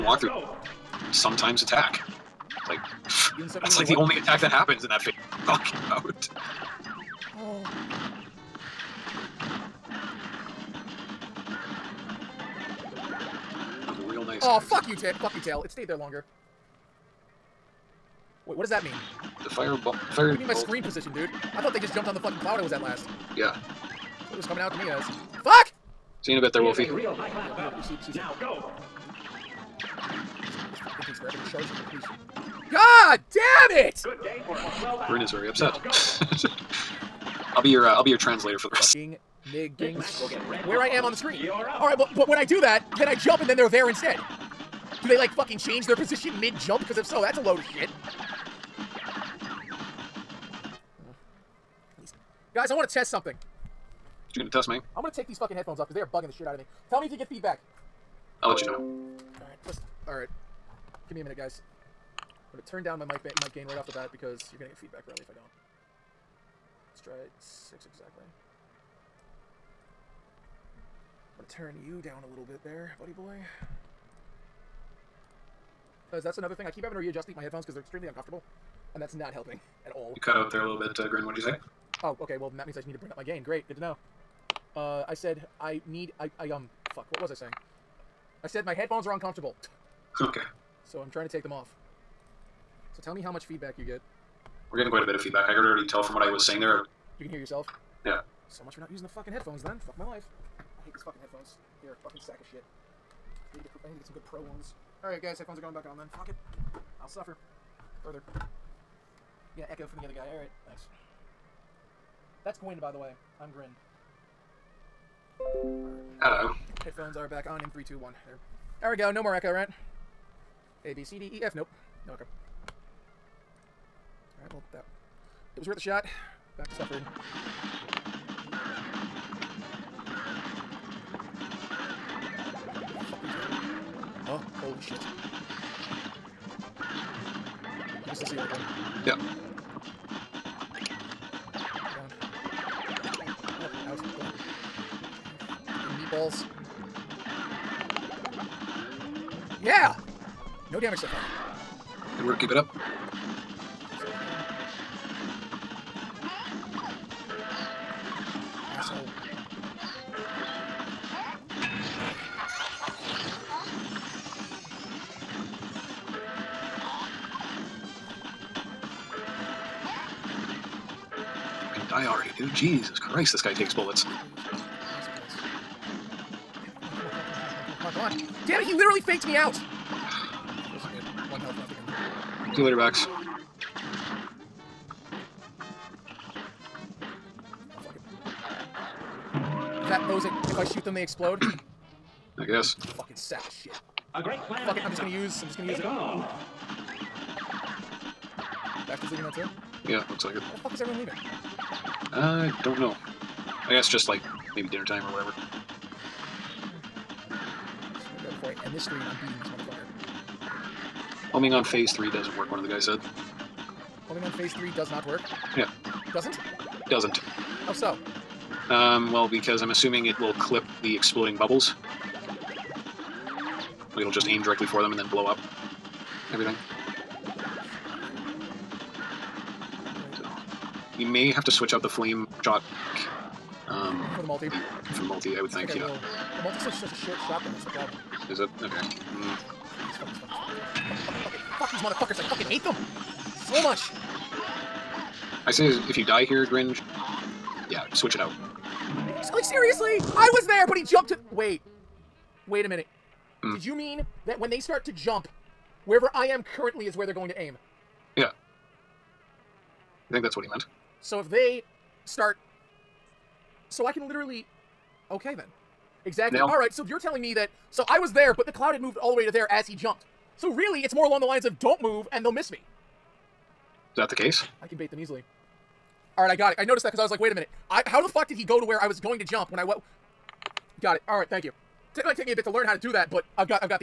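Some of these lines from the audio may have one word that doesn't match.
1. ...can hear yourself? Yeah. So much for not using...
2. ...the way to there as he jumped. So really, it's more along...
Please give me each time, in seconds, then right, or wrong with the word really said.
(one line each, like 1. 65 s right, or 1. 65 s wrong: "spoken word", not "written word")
1. 97 s right
2. 269 s right.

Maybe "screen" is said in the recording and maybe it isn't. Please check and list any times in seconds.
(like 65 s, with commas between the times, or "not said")
20 s, 41 s.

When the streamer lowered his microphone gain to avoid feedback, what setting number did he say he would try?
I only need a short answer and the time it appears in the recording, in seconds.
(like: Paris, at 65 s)
6, at 67 s.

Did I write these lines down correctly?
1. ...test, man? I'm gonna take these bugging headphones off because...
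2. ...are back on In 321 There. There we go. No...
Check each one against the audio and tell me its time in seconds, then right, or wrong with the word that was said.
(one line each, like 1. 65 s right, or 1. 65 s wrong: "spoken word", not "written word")
1. 54 s wrong: "fucking", not "bugging"
2. 117 s right.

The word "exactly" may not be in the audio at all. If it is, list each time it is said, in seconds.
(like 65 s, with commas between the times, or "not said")
67 s, 266 s.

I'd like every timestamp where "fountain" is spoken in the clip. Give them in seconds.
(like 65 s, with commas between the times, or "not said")
not said.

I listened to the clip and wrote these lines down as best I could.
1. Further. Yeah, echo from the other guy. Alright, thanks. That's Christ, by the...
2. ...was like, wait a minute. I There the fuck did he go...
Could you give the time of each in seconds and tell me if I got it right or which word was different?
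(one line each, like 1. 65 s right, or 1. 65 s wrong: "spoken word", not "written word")
1. 108 s wrong: "Gwyn", not "Christ"
2. 277 s wrong: "How", not "There".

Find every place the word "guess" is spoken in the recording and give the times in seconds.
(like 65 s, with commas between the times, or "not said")
192 s, 203 s.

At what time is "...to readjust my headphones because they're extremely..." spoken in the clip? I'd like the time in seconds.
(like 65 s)
76 s.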